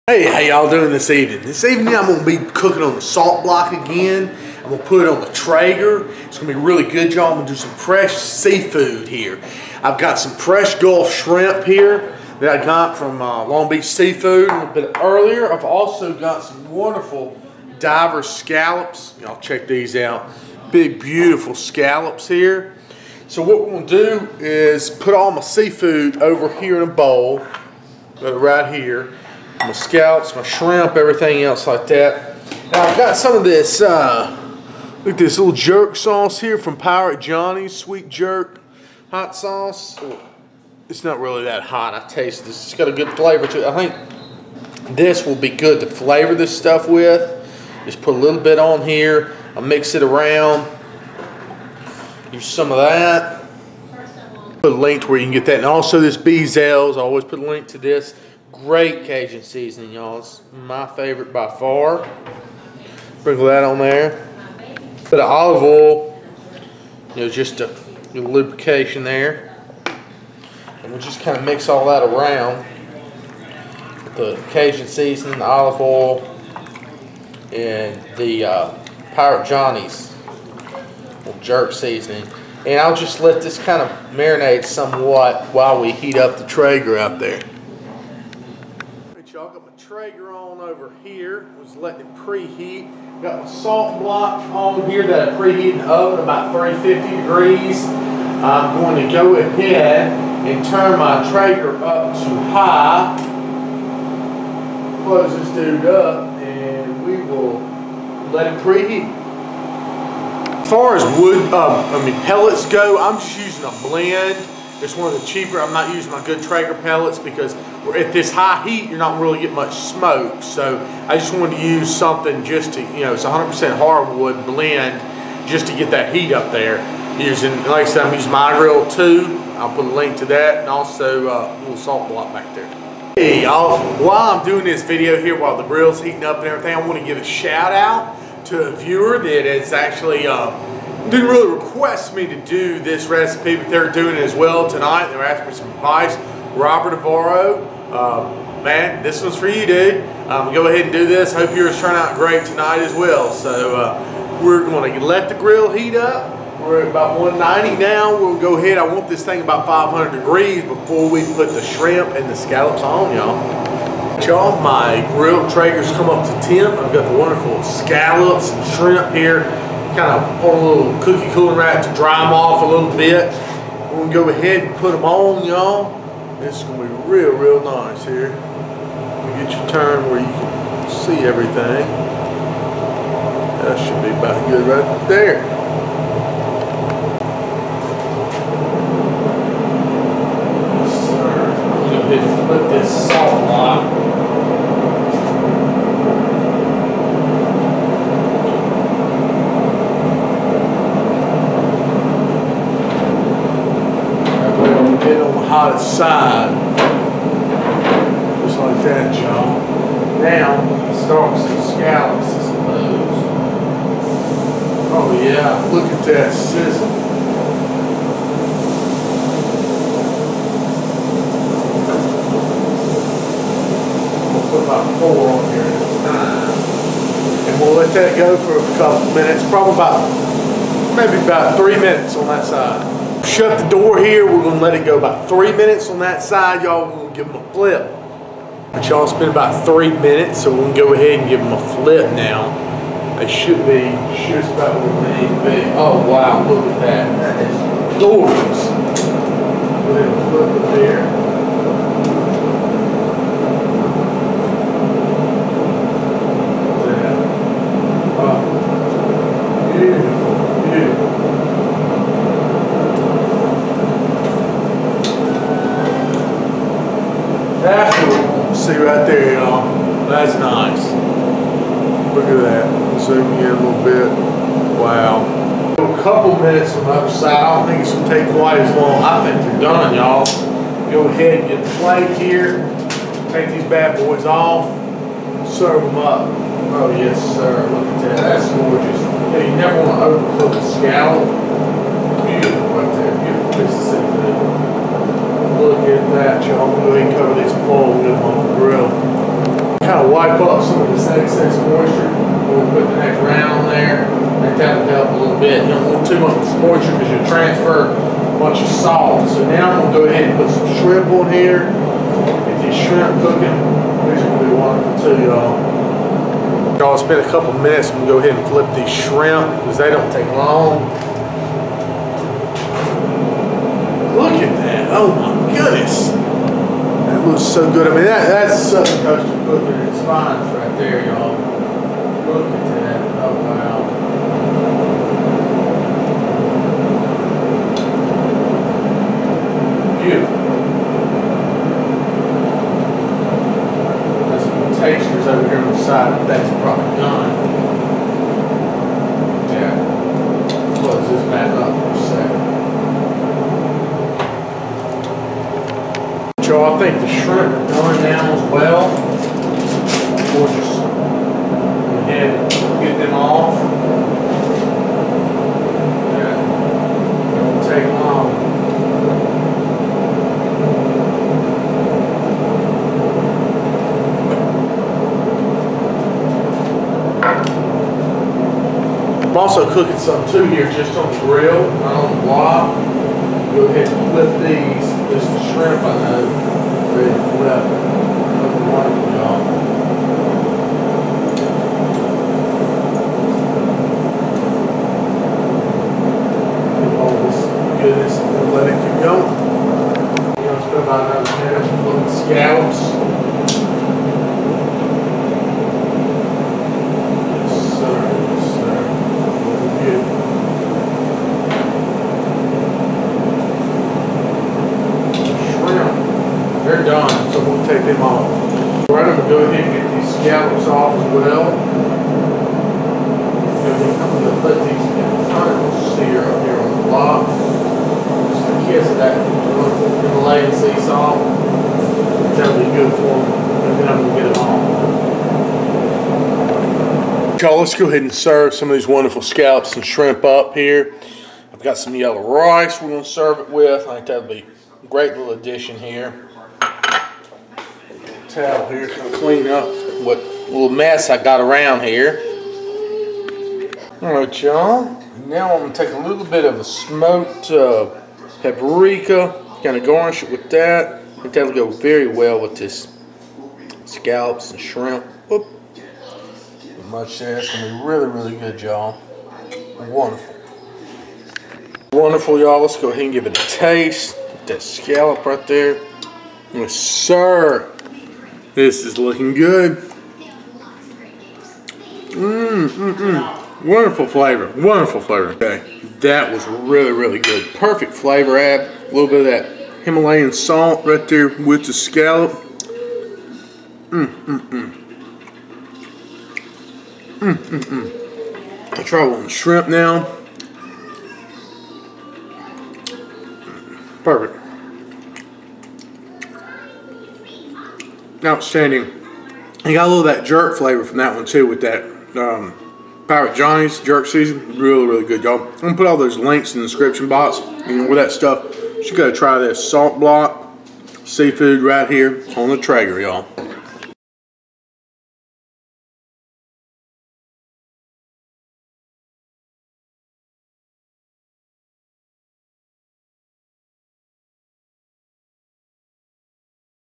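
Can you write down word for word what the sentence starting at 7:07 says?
Just a kiss of that delay and seesaw.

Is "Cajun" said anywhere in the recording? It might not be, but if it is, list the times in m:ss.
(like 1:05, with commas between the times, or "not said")
0:59, 1:14.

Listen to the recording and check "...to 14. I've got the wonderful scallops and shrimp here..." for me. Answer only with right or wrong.
wrong.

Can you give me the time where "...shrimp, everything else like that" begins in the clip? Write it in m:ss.
0:30.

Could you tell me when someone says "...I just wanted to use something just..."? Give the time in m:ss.
2:01.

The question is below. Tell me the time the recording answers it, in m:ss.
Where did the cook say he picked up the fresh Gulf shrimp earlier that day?
0:13.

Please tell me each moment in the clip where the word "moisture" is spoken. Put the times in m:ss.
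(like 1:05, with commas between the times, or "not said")
5:01, 5:06.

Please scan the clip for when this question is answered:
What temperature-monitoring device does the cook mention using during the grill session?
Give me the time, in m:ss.
2:08.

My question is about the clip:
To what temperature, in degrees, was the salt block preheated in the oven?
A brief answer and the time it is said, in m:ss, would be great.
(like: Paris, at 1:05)
350, at 1:36.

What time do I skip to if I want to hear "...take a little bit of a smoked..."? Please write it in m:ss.
7:35.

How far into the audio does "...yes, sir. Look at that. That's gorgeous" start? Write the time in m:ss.
4:46.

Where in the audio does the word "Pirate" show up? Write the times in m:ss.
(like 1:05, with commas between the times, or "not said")
0:36, 1:19, 8:33.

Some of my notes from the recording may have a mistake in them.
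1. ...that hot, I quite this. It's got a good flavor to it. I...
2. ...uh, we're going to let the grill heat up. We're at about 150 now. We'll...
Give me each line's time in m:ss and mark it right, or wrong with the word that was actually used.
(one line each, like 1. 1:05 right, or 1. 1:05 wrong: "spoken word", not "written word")
1. 0:41 wrong: "taste", not "quite"
2. 2:33 wrong: "190", not "150".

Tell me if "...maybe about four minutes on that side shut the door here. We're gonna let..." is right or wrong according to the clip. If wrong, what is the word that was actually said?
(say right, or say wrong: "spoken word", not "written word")
wrong: "three", not "four".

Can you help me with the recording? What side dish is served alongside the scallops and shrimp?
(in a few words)
yellow rice.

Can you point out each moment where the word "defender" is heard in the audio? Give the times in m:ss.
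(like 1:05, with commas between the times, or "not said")
not said.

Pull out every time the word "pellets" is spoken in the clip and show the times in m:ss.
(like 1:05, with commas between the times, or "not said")
1:52, 1:56.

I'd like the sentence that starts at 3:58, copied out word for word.
But y'all, it's been about three minutes, so we're gonna go ahead and give them a flip now.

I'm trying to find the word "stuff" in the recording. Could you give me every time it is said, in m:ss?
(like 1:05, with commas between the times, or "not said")
0:46, 8:38.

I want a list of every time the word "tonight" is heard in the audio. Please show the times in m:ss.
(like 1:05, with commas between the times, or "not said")
2:24, 2:32.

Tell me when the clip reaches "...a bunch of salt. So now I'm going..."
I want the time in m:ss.
5:07.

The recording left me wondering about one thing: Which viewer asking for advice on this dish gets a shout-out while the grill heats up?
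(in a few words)
Robert Navarro.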